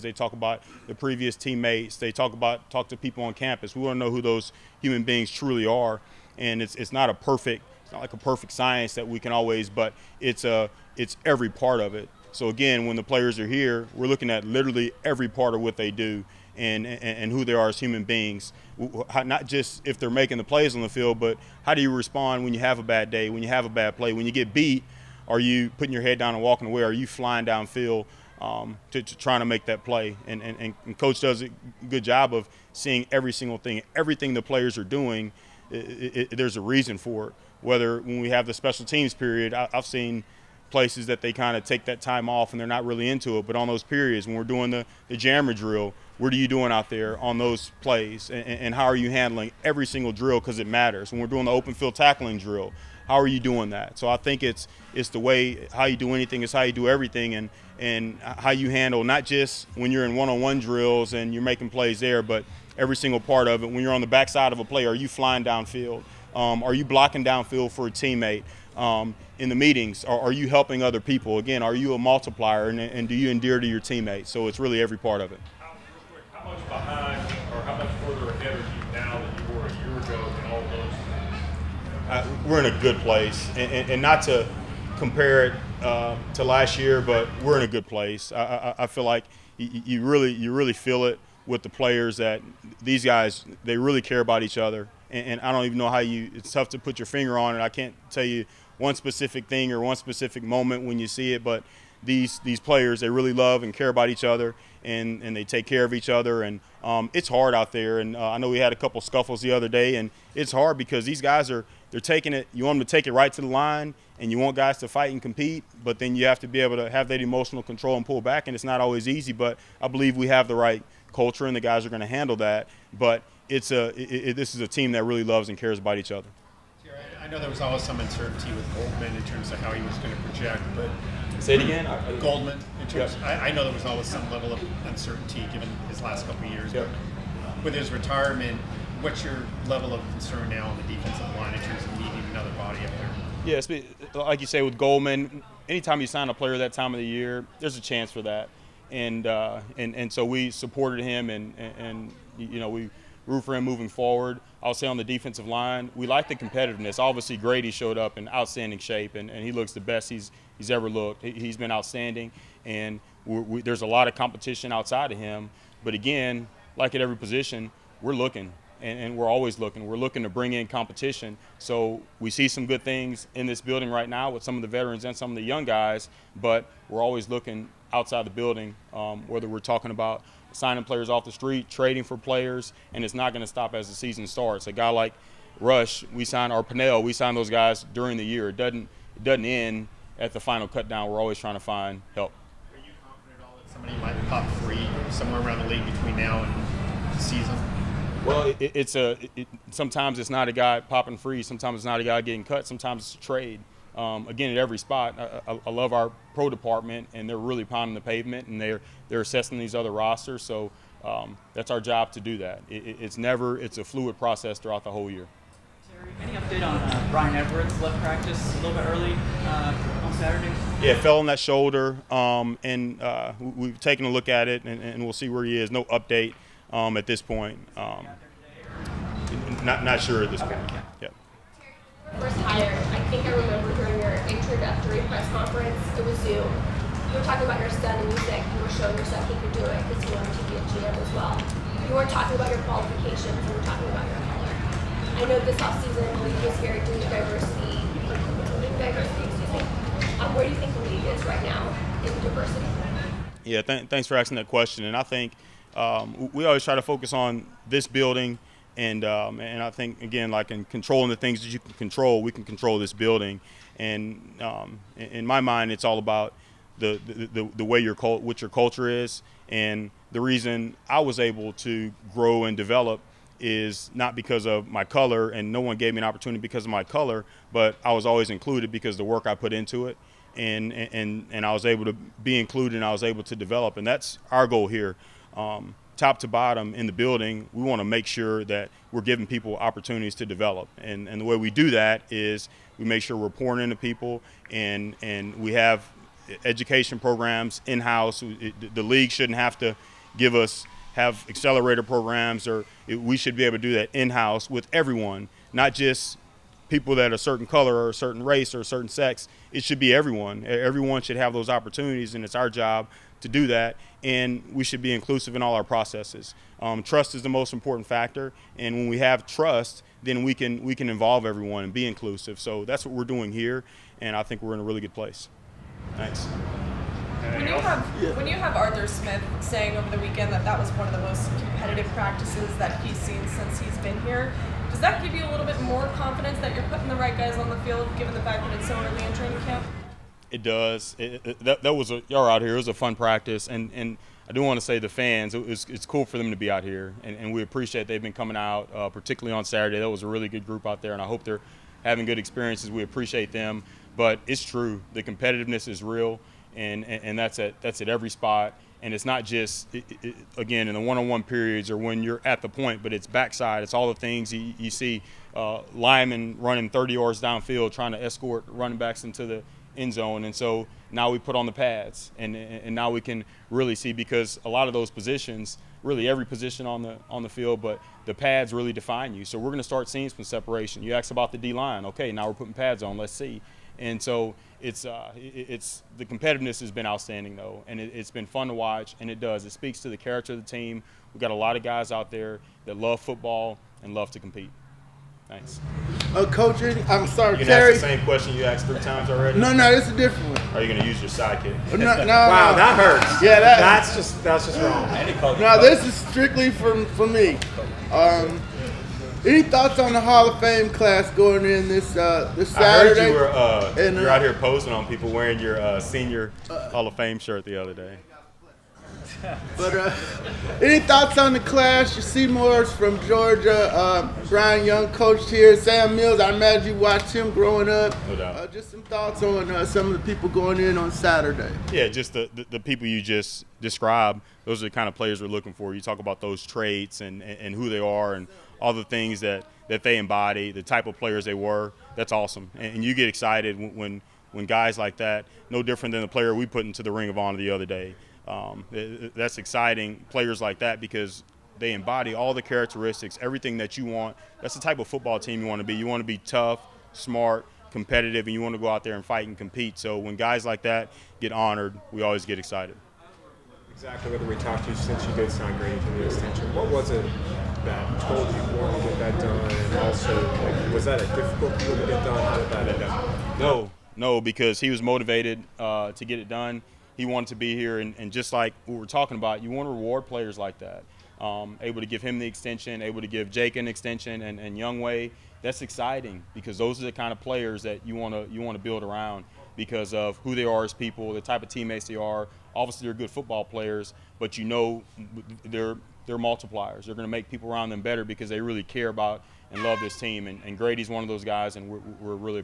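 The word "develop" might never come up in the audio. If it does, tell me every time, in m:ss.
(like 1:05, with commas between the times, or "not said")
4:32, 4:43, 4:50.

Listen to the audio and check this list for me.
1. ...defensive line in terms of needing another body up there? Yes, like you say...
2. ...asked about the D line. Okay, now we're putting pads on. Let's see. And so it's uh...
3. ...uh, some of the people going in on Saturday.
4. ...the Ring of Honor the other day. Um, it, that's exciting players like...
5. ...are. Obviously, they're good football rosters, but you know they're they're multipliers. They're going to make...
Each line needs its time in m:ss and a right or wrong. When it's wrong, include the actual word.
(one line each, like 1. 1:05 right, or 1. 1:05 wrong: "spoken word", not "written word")
1. 2:20 right
2. 6:20 right
3. 7:09 right
4. 7:26 right
5. 8:11 wrong: "players", not "rosters".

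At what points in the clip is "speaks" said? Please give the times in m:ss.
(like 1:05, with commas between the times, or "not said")
6:29.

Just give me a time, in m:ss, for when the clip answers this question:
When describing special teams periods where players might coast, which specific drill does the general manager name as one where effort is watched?
0:45.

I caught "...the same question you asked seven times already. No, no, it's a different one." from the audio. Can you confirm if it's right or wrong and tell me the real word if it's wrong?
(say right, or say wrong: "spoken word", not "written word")
wrong: "three", not "seven".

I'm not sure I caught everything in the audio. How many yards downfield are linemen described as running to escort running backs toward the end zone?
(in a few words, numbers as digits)
30.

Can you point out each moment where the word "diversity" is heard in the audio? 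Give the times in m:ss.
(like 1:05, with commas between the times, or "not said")
4:06, 4:12.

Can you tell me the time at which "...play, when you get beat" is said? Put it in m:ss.
0:23.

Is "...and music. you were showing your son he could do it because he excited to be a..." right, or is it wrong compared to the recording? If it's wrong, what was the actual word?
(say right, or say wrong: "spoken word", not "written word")
wrong: "wanted", not "excited".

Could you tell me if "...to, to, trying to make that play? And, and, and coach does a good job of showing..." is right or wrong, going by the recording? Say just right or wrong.
wrong.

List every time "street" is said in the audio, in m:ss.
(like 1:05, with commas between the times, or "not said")
3:01.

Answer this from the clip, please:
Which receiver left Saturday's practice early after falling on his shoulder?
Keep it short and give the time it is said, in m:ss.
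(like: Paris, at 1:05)
Bryan Edwards, at 3:37.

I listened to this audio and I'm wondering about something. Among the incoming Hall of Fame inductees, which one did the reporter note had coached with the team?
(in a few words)
Bryant Young.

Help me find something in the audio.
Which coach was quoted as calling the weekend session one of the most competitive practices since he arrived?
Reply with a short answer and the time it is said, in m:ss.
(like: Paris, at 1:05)
Arthur Smith, at 5:28.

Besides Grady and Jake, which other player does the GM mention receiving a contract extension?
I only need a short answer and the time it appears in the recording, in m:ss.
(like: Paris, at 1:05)
Younghoe, at 8:04.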